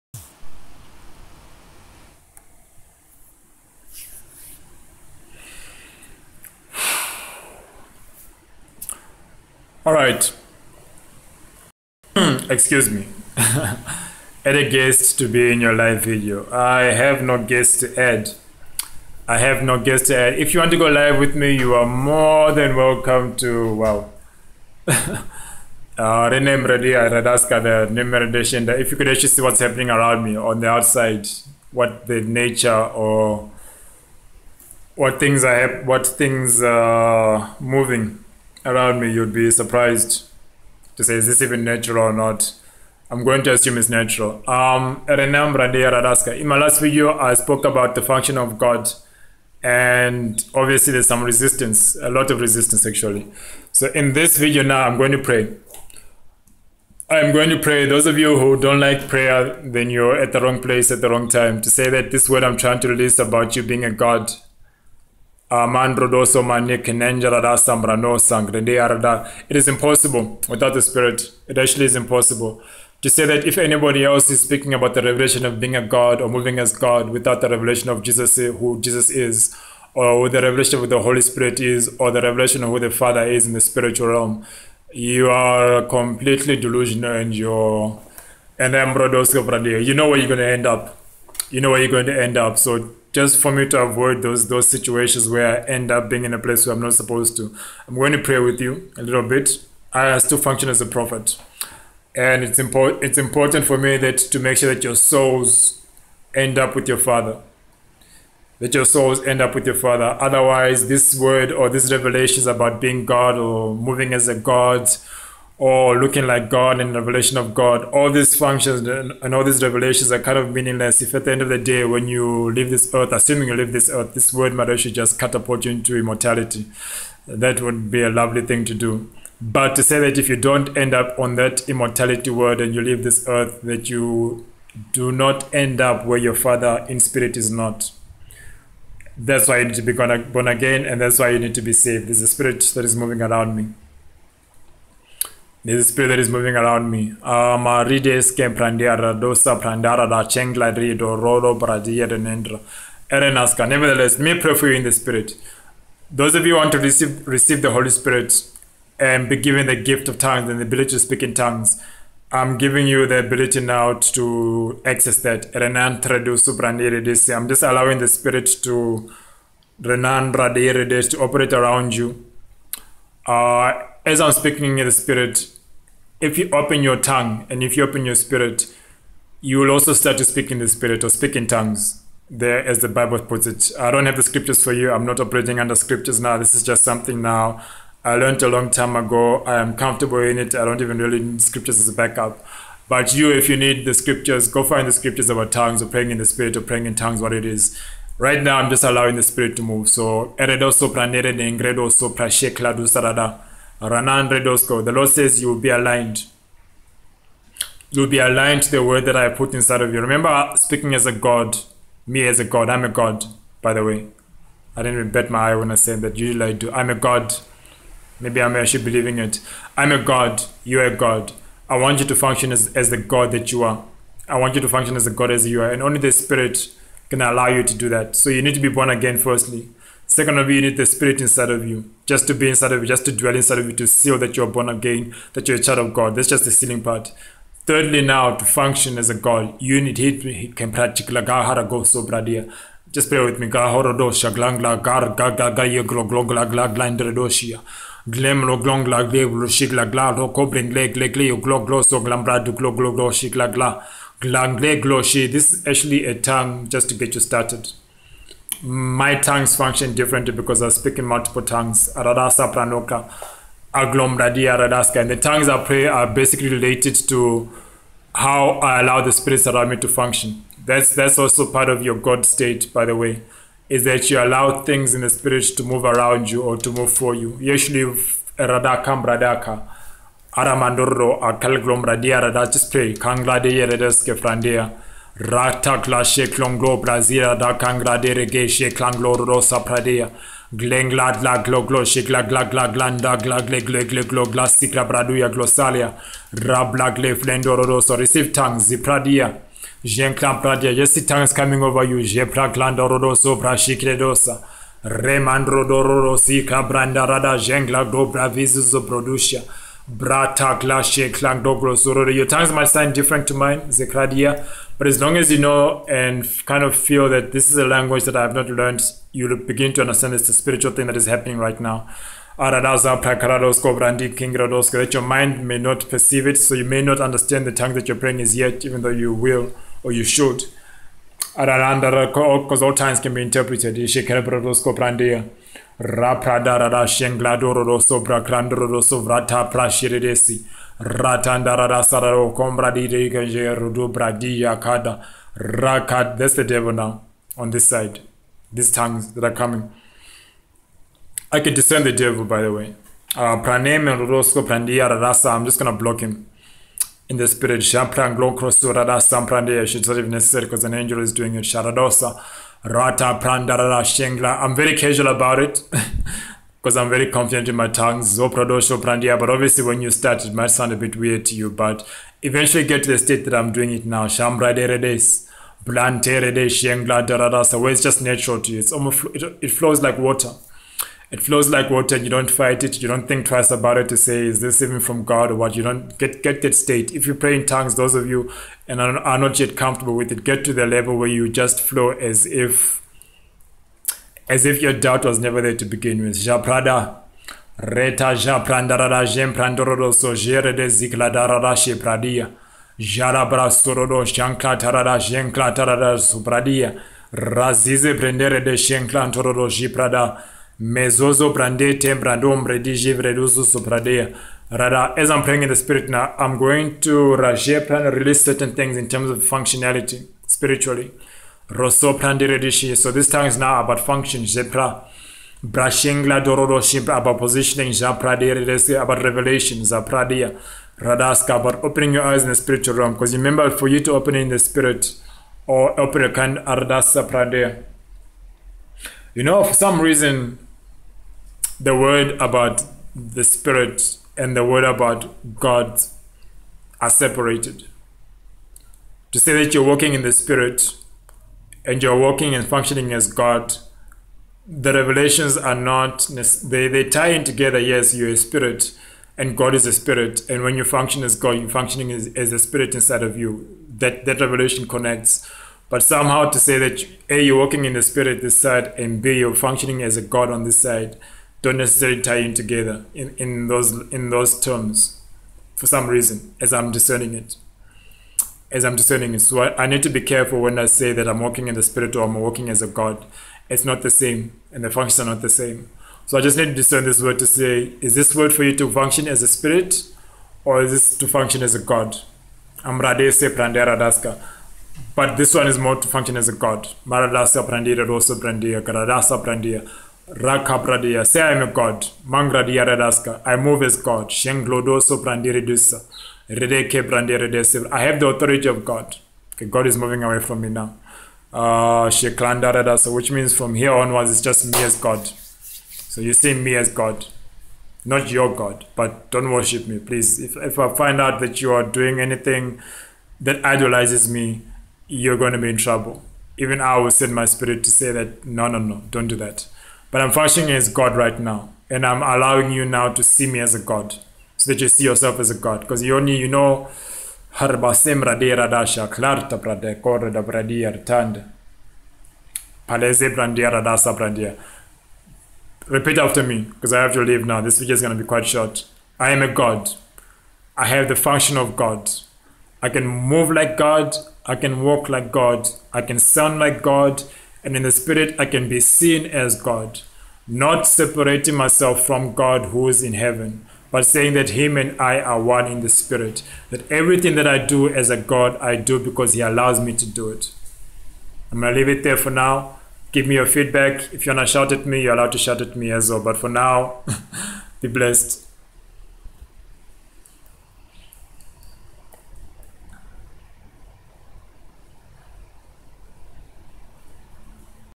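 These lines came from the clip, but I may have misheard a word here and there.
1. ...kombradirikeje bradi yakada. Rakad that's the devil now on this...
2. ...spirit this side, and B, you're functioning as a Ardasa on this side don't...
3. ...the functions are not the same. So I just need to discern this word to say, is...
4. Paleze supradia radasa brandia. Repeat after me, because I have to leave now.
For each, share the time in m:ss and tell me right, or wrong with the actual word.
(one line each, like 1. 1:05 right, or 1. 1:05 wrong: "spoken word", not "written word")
1. 5:42 right
2. 7:47 wrong: "God", not "Ardasa"
3. 8:04 right
4. 9:02 wrong: "brandia", not "supradia".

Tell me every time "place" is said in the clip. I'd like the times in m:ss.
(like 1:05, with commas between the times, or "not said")
1:00, 1:36.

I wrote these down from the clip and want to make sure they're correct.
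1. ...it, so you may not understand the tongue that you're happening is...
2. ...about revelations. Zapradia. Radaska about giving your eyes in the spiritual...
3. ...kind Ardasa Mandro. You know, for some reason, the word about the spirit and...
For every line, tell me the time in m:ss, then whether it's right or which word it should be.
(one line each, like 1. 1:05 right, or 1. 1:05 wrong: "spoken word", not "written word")
1. 5:26 wrong: "praying", not "happening"
2. 7:08 wrong: "opening", not "giving"
3. 7:16 wrong: "Pradea", not "Mandro".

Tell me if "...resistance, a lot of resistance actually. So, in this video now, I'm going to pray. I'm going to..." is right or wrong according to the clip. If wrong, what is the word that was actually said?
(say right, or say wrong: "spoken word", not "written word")
right.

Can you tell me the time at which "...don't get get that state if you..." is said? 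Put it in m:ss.
6:25.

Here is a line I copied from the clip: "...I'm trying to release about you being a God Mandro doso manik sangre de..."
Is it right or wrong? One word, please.
right.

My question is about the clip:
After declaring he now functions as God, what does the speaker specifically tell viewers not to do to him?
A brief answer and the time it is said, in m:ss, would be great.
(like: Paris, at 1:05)
worship me, at 8:39.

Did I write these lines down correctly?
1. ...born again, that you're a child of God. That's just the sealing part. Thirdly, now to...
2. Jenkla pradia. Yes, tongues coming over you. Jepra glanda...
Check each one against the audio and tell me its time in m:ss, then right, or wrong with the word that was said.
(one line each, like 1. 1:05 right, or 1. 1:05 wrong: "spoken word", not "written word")
1. 3:54 right
2. 4:59 right.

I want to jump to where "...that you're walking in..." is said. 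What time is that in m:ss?
7:29.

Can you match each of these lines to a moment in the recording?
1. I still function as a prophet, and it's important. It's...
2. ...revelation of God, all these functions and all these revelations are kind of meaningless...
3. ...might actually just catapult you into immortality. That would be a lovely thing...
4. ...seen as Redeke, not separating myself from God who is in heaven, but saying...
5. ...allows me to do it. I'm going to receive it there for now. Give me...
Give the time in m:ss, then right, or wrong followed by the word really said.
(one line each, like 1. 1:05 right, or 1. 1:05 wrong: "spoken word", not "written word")
1. 1:39 right
2. 1:56 right
3. 2:04 right
4. 9:18 wrong: "God", not "Redeke"
5. 9:29 wrong: "leave", not "receive".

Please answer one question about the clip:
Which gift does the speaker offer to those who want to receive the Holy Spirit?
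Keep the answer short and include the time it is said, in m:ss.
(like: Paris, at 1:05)
gift of tongues, at 2:39.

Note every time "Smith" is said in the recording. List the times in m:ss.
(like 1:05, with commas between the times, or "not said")
not said.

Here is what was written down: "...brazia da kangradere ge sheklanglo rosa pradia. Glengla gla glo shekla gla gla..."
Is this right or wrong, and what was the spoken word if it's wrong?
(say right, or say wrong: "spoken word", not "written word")
right.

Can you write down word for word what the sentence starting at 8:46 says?
Even I will send my spirit to say that, no, no, no, don't do that.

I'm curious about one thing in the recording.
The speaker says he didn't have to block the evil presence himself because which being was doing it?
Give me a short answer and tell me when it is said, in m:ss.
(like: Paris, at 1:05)
an angel, at 6:00.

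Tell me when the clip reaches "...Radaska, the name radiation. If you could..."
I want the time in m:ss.
0:26.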